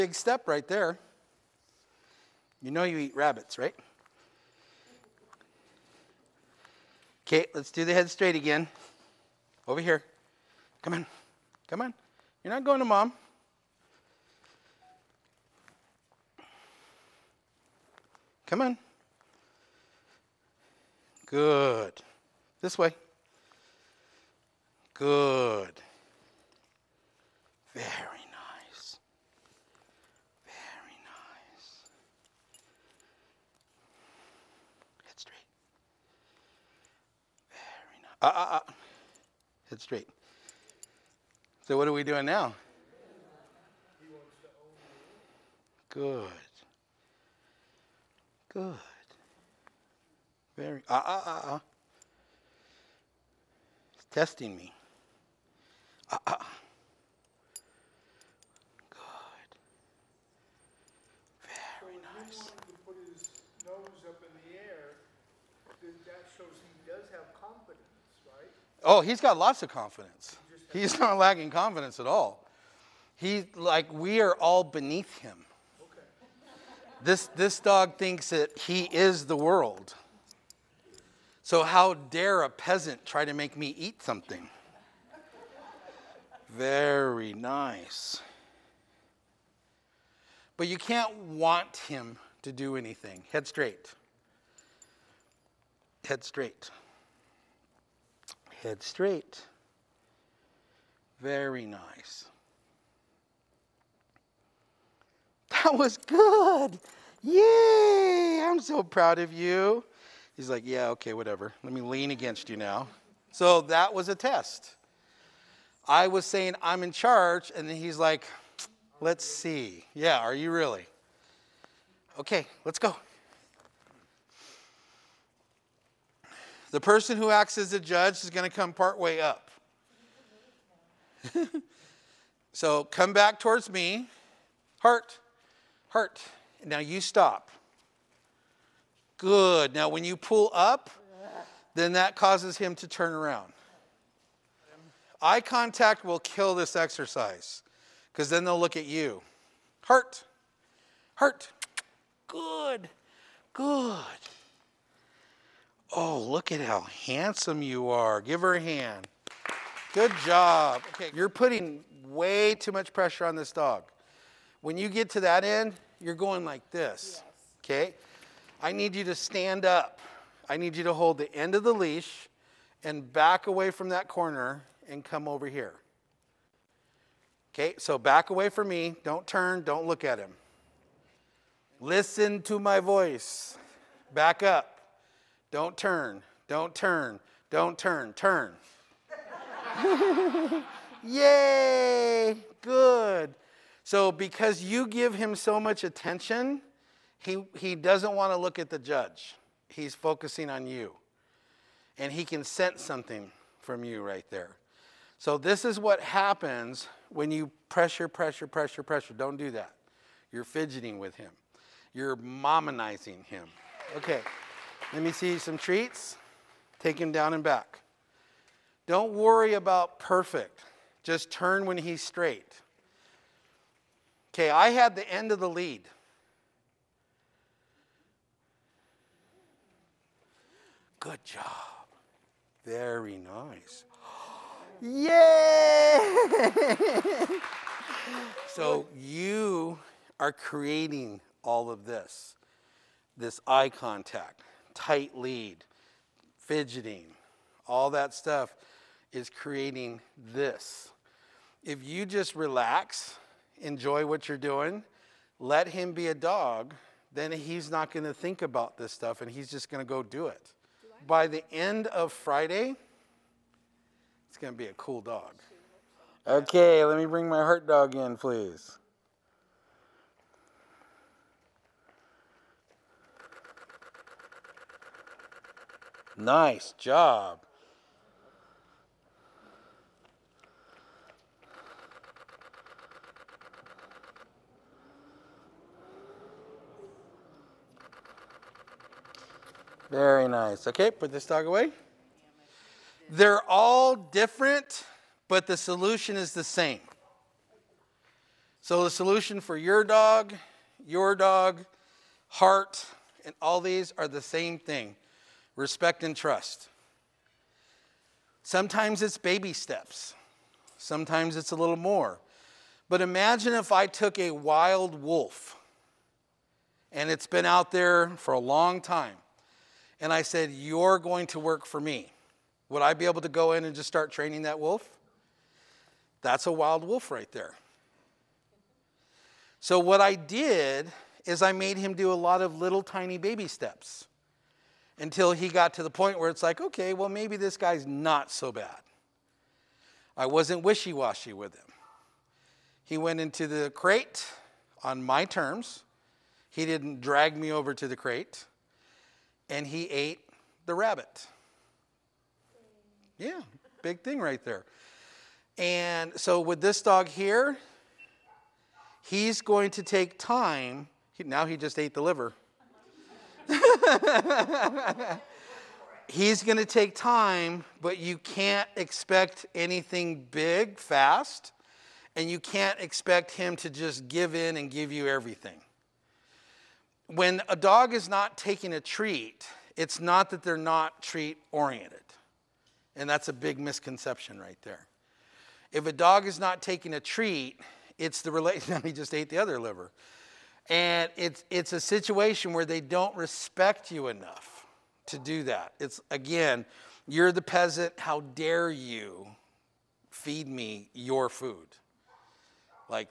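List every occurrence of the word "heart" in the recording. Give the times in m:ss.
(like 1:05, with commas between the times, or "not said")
2:14, 4:27, 5:02.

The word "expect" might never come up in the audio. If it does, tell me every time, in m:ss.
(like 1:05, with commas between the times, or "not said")
6:08, 6:12.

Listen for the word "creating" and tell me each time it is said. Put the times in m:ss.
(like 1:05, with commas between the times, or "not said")
4:00, 4:09.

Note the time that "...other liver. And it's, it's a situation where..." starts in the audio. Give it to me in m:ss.
6:29.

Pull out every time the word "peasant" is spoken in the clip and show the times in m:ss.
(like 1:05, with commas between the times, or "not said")
1:22, 6:37.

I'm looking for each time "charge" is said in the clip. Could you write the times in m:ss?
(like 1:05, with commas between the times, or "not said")
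1:56.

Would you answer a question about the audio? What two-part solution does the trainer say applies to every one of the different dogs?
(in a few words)
Respect and trust.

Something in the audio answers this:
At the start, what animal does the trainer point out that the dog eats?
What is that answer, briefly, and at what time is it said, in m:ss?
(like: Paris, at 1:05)
Rabbits, at 0:03.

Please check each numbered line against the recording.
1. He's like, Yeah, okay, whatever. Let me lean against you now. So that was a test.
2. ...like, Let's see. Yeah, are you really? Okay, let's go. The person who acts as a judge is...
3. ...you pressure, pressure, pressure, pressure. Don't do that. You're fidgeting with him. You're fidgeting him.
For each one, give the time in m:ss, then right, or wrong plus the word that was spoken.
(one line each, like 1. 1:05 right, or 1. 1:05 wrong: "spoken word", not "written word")
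1. 1:50 right
2. 1:57 right
3. 3:27 wrong: "mominizing", not "fidgeting".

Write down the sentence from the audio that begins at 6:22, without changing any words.
And that's a big misconception right there.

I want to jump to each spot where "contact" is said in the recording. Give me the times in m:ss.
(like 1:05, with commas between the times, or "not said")
2:25, 4:03.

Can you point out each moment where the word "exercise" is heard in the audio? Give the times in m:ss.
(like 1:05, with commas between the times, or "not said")
2:26.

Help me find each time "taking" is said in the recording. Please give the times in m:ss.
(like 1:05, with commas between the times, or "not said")
6:18, 6:26.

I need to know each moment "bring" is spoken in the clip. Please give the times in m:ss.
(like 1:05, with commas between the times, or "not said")
4:27.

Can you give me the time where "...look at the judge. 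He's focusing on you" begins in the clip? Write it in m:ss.
3:18.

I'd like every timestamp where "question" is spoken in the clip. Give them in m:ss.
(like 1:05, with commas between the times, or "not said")
not said.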